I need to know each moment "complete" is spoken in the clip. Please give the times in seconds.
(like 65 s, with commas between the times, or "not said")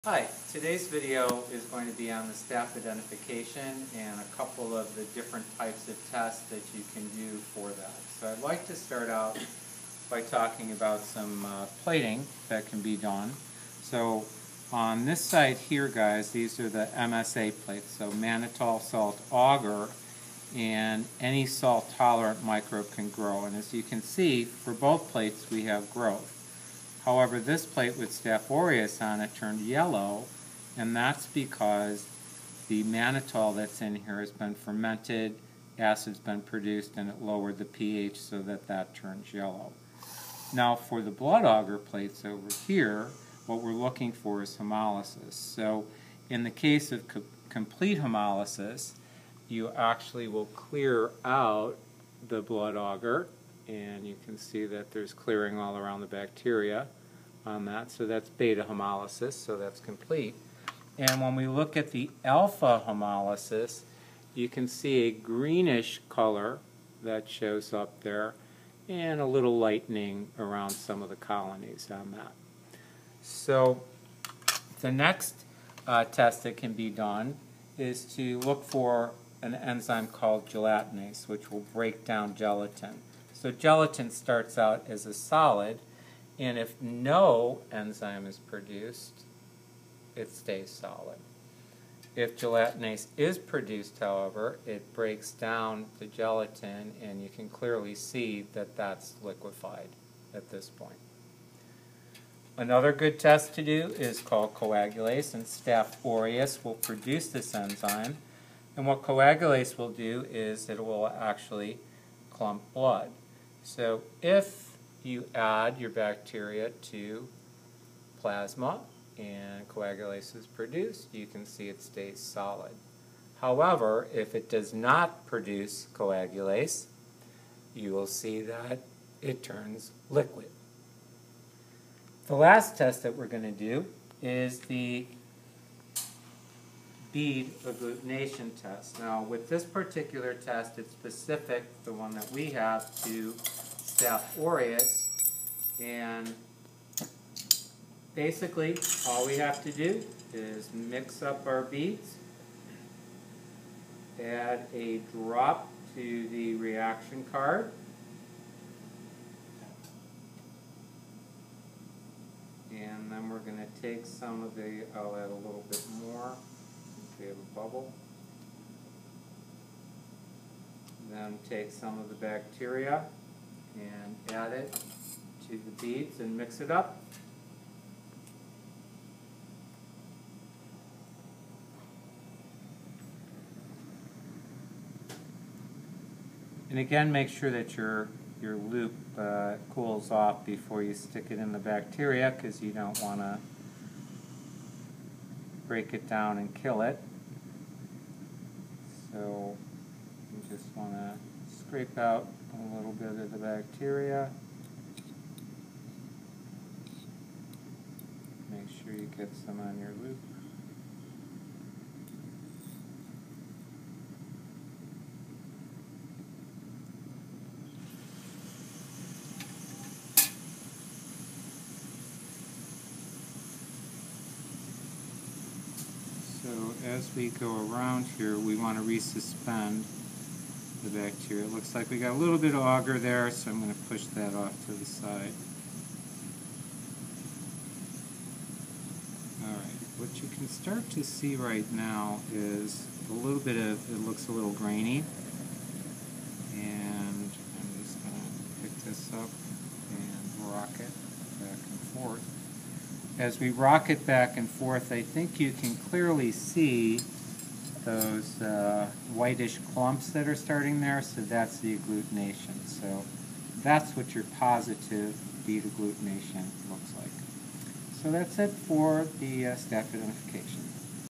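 47 s, 59 s.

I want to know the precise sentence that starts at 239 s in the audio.
All right, what you can start to see right now is a little bit of, it looks a little grainy.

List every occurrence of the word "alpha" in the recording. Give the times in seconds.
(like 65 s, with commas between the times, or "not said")
62 s.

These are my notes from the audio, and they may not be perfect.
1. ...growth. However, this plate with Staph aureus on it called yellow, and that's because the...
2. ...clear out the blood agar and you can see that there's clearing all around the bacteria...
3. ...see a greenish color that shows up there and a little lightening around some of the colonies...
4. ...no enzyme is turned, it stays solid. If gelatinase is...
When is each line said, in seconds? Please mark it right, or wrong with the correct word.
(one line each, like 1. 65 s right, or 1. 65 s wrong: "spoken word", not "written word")
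1. 25 s wrong: "turned", not "called"
2. 50 s right
3. 64 s right
4. 86 s wrong: "produced", not "turned".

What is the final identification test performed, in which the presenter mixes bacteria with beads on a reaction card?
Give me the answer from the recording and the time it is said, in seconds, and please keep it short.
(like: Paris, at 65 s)
Bead agglutination test, at 137 s.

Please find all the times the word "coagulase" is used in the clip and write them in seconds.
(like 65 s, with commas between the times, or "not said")
104 s, 109 s, 119 s, 125 s.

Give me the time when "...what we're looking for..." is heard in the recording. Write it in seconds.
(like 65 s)
43 s.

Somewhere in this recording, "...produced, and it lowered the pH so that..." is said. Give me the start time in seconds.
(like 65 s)
36 s.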